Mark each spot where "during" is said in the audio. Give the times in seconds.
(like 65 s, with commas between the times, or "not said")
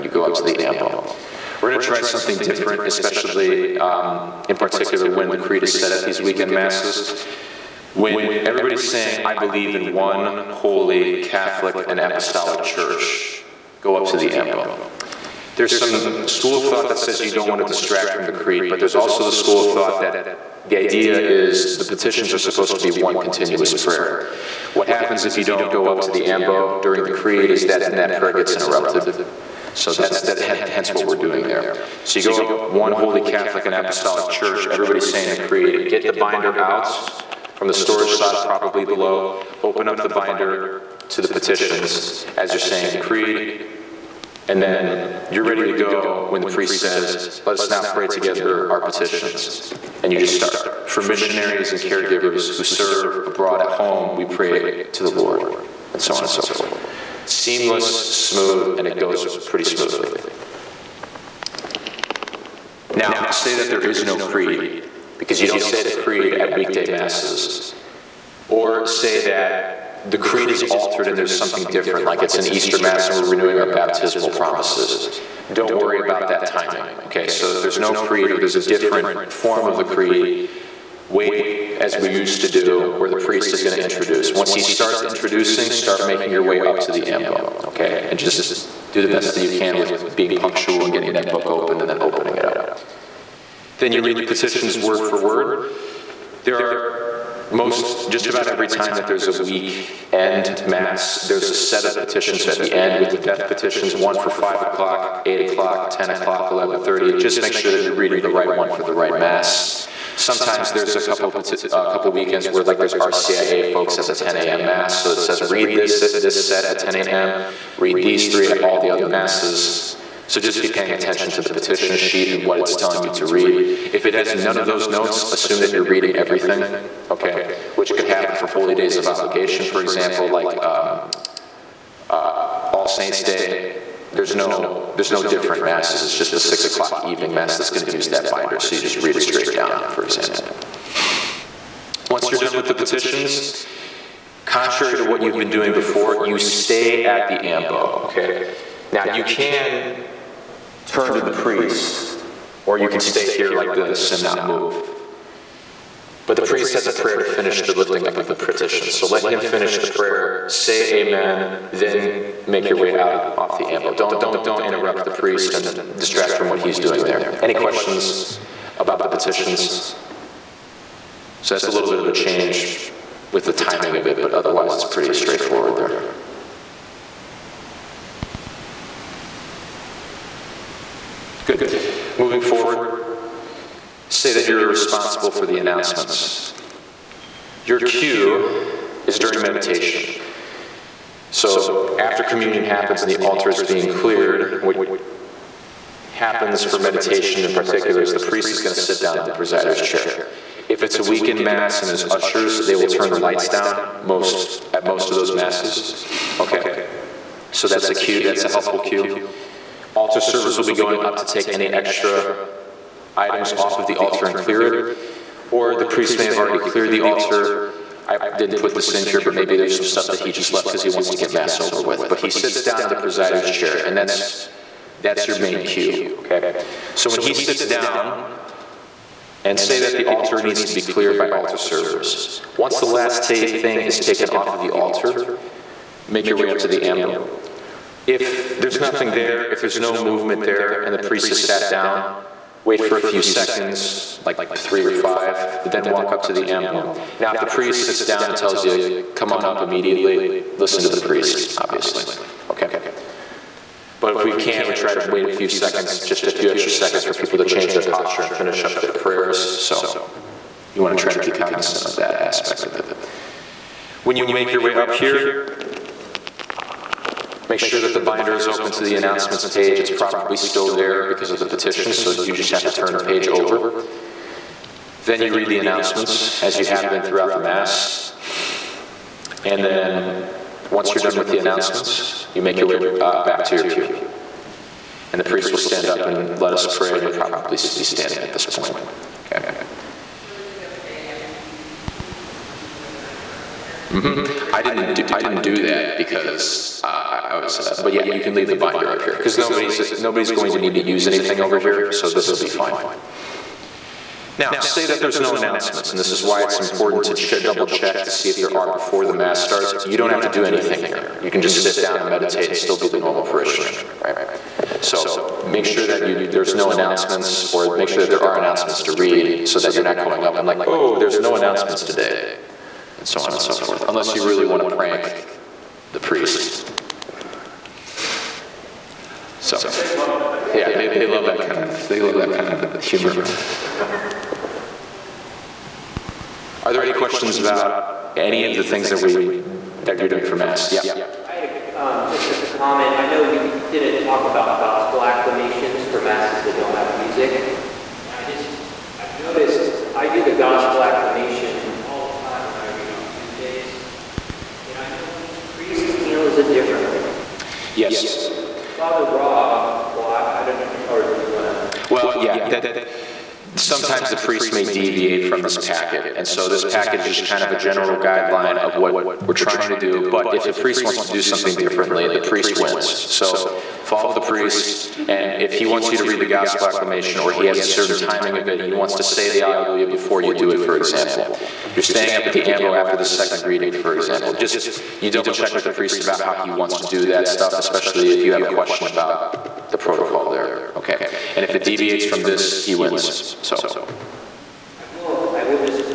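26 s, 189 s.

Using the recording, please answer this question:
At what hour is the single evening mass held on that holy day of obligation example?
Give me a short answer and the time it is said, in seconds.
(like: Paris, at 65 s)
6 o'clock, at 136 s.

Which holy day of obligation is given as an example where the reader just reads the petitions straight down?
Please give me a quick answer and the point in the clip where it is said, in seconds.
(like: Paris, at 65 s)
All Saints Day, at 132 s.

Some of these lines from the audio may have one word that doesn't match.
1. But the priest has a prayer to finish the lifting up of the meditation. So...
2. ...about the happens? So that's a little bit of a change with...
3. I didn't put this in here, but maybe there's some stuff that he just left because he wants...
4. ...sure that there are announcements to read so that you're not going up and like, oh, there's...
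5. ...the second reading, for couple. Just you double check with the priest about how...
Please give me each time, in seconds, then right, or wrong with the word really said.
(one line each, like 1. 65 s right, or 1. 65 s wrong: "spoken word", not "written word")
1. 156 s wrong: "petition", not "meditation"
2. 168 s wrong: "petitions", not "happens"
3. 218 s right
4. 317 s right
5. 382 s wrong: "example", not "couple".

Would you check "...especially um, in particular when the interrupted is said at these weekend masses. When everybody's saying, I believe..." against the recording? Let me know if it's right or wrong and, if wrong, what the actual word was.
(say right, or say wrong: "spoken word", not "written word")
wrong: "creed", not "interrupted".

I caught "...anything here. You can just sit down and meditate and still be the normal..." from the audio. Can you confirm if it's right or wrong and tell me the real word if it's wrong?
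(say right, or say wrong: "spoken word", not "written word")
right.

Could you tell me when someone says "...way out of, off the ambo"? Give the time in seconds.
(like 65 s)
162 s.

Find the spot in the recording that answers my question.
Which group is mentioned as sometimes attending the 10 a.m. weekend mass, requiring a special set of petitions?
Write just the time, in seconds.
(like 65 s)
112 s.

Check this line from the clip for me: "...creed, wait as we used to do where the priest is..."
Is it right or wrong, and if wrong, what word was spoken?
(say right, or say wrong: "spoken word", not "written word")
right.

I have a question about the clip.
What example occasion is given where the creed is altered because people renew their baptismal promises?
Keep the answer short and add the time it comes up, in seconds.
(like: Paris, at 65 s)
Easter mass, at 72 s.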